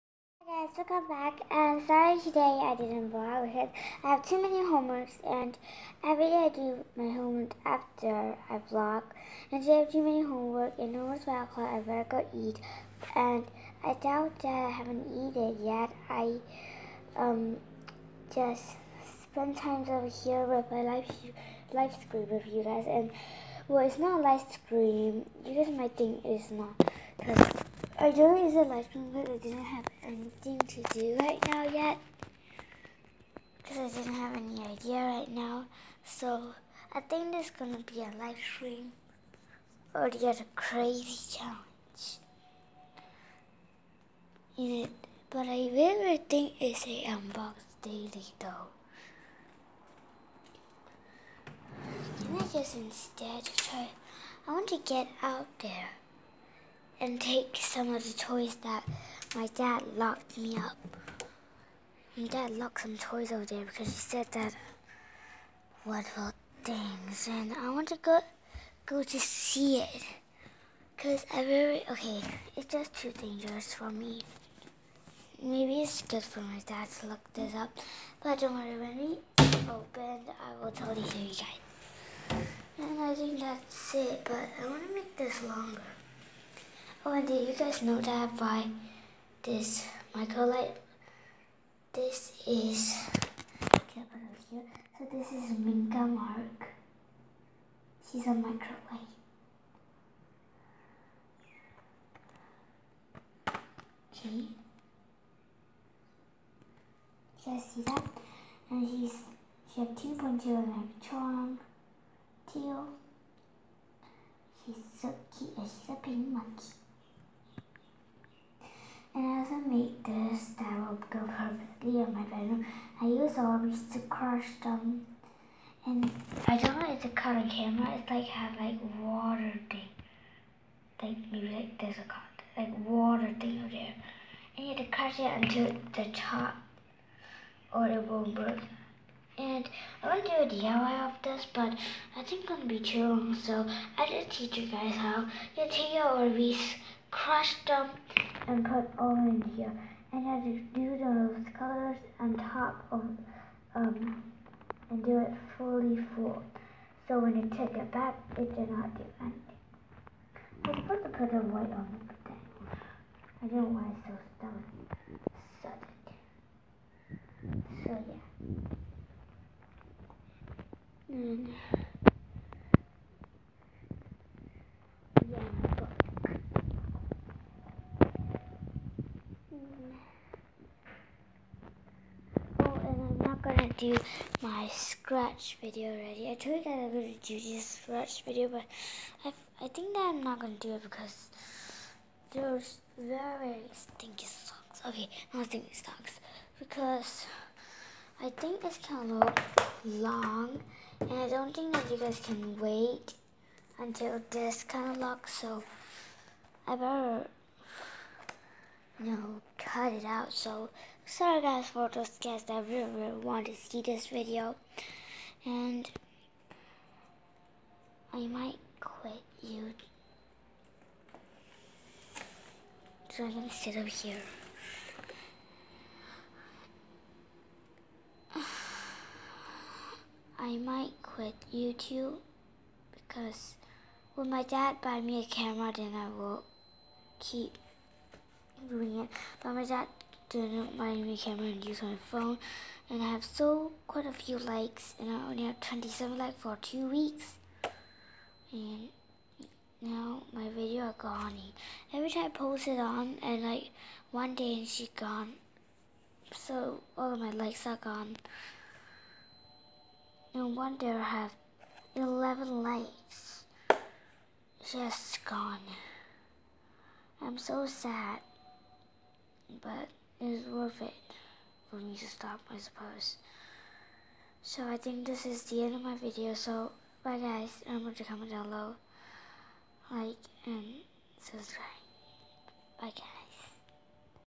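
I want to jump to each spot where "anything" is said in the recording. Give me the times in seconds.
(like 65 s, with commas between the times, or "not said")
30 s, 159 s.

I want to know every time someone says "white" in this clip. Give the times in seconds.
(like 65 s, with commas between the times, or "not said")
161 s.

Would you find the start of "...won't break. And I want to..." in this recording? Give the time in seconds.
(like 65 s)
138 s.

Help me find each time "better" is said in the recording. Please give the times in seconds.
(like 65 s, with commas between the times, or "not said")
11 s, 206 s.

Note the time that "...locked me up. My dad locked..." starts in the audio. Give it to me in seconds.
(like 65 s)
59 s.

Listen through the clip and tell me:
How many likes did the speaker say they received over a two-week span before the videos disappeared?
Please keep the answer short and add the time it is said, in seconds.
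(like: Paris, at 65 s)
27, at 245 s.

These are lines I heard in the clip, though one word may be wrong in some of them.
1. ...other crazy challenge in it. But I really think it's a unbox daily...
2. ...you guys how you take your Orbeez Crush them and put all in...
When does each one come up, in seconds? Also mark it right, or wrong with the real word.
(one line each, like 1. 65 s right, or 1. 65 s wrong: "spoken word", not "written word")
1. 40 s right
2. 144 s right.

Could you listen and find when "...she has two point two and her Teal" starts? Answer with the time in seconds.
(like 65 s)
109 s.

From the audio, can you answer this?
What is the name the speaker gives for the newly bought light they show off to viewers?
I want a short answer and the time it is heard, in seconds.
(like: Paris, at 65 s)
Minka Mark, at 95 s.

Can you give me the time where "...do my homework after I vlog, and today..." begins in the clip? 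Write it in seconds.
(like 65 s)
6 s.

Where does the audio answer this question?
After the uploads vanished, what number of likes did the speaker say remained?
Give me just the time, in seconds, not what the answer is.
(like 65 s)
261 s.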